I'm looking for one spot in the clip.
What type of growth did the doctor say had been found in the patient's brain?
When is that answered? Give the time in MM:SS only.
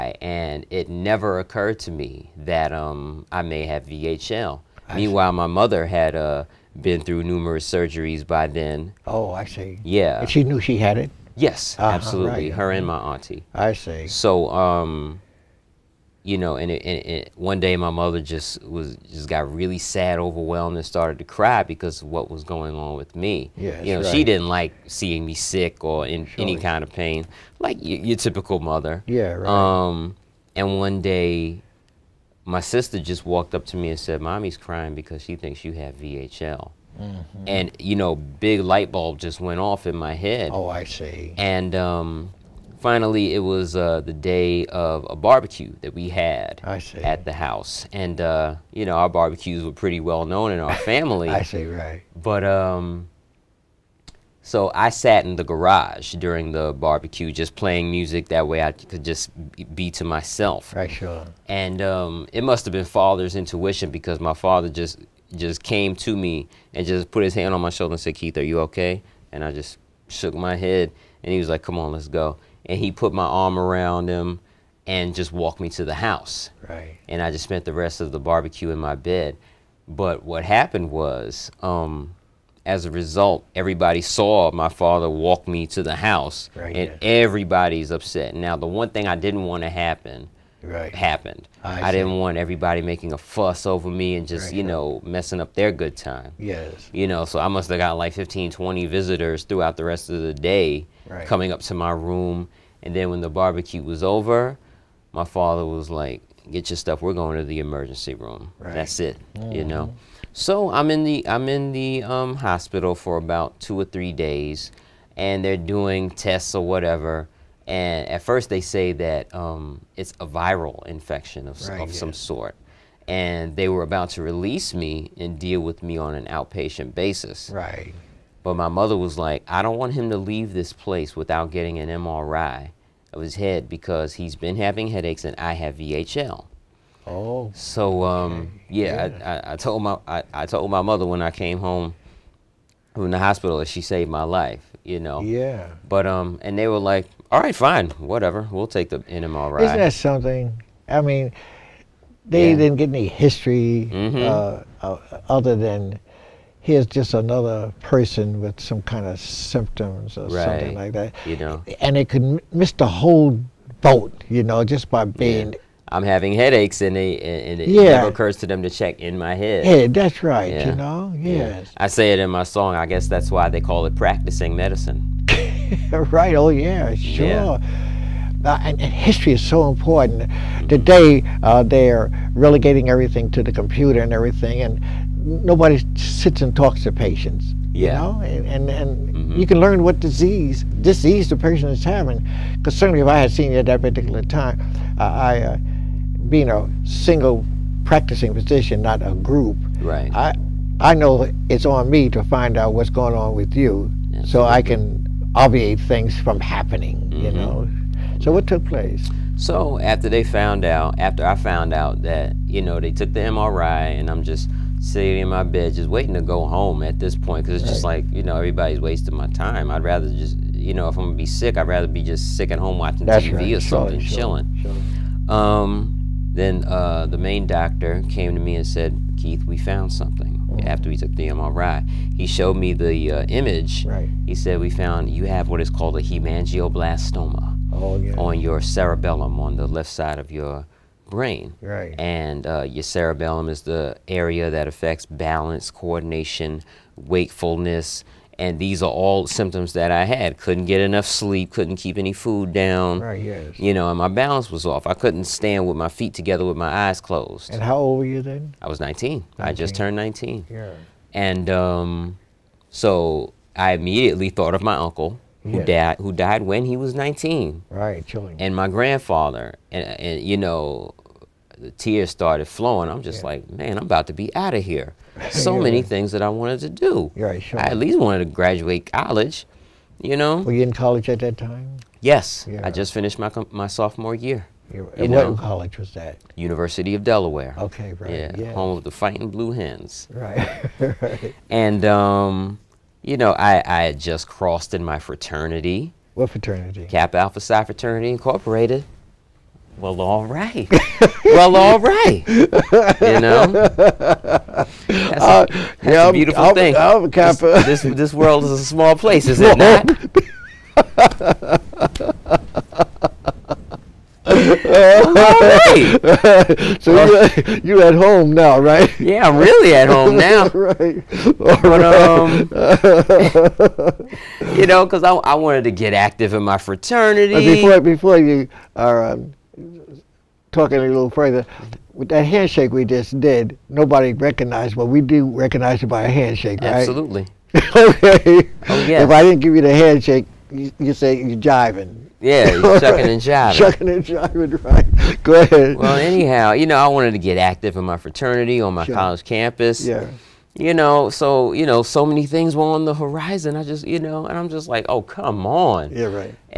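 03:56.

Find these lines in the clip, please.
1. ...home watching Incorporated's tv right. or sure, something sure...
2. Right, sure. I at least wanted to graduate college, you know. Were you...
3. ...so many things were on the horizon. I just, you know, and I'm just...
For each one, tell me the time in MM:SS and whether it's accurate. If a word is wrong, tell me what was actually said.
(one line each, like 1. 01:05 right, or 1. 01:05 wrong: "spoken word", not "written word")
1. 03:42 wrong: "That", not "Incorporated"
2. 04:37 right
3. 05:51 right.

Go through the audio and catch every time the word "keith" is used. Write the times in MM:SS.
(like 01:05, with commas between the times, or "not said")
01:08, 03:49.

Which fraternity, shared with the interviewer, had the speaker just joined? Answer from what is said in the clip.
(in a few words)
Kappa Alpha Psi.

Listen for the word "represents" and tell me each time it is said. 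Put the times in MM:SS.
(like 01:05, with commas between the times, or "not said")
not said.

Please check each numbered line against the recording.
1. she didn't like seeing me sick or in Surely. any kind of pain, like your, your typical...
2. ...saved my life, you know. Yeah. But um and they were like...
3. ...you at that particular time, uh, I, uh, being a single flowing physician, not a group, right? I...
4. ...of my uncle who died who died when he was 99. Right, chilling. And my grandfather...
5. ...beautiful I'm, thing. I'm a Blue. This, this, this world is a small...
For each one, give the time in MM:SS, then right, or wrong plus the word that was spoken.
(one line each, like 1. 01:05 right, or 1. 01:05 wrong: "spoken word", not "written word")
1. 00:24 right
2. 02:23 right
3. 03:13 wrong: "practicing", not "flowing"
4. 04:24 wrong: "19", not "99"
5. 05:06 wrong: "Kappa", not "Blue".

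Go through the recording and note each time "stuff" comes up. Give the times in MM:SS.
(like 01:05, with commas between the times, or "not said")
01:46.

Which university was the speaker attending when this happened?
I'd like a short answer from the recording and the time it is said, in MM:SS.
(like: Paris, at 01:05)
University of Delaware, at 04:46.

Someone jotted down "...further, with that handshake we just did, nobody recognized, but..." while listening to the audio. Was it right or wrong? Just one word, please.
right.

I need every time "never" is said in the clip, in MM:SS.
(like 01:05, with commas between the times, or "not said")
00:00, 02:47.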